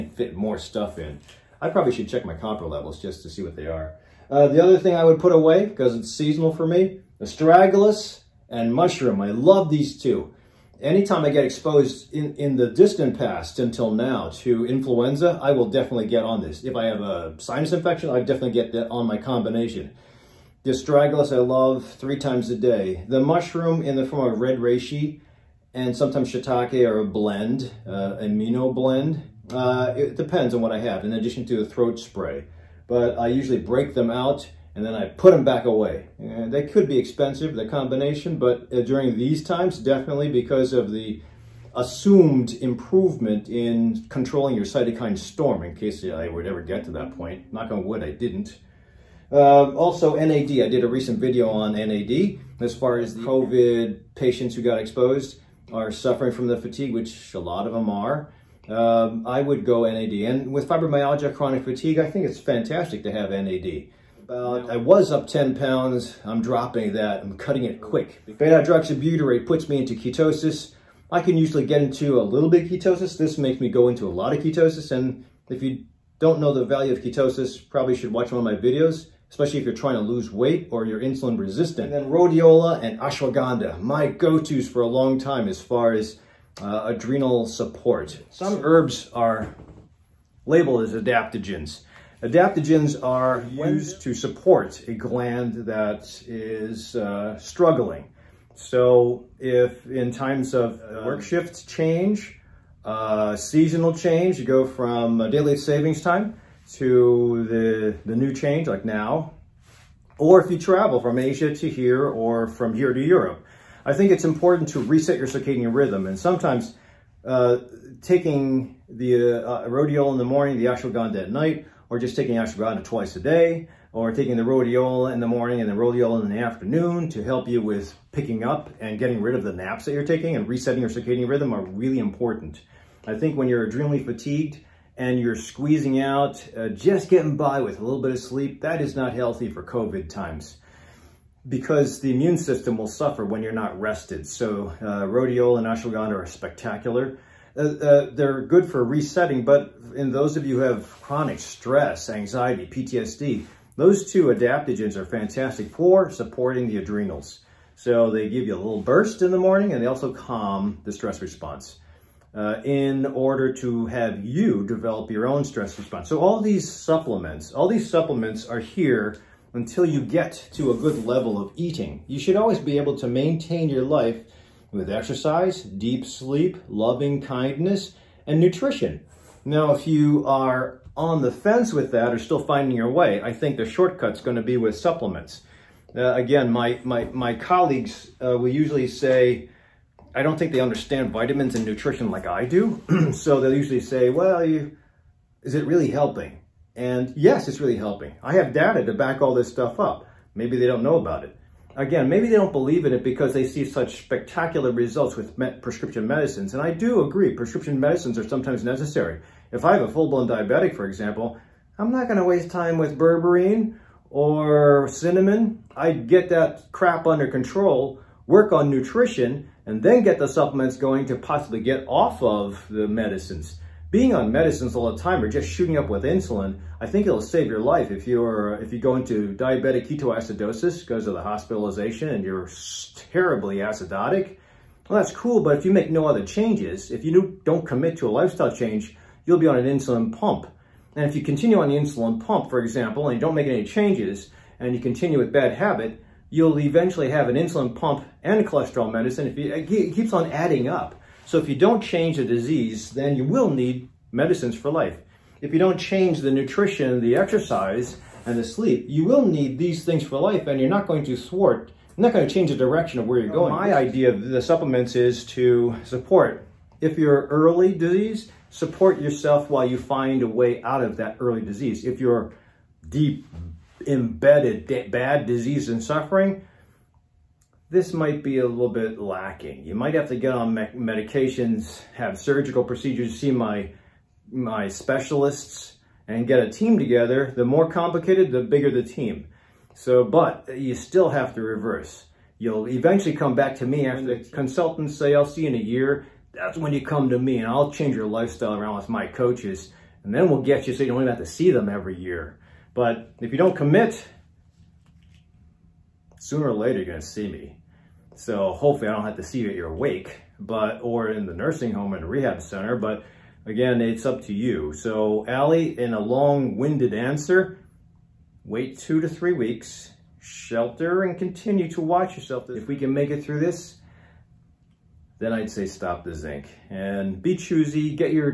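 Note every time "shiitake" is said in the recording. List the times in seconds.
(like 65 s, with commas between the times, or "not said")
26 s.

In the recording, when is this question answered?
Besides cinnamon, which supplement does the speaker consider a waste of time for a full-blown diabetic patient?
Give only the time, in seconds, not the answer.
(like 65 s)
212 s.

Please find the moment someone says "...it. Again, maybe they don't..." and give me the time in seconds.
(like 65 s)
201 s.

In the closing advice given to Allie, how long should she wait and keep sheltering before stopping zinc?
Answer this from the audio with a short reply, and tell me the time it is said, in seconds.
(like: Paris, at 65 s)
2 to 3 weeks, at 318 s.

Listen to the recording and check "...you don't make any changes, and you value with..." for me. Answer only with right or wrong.
wrong.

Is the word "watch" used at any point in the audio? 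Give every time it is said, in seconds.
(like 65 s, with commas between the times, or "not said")
78 s, 321 s.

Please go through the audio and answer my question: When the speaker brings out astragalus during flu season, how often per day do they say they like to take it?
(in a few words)
3 times a day.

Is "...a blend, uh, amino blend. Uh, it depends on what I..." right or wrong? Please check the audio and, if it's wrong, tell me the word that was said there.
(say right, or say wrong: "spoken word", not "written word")
right.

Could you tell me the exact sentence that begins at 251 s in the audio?
So if you don't change the disease, then you will need medicines for life.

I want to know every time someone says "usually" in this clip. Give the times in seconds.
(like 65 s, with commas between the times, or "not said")
33 s, 71 s, 188 s, 193 s.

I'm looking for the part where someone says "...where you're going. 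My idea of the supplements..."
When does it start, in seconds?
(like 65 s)
263 s.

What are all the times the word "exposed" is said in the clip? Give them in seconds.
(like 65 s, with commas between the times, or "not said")
11 s, 54 s.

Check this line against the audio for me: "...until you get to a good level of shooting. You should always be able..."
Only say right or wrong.
wrong.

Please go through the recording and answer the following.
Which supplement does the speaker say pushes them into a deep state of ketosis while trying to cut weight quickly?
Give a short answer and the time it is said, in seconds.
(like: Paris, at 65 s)
Beta-hydroxybutyrate, at 68 s.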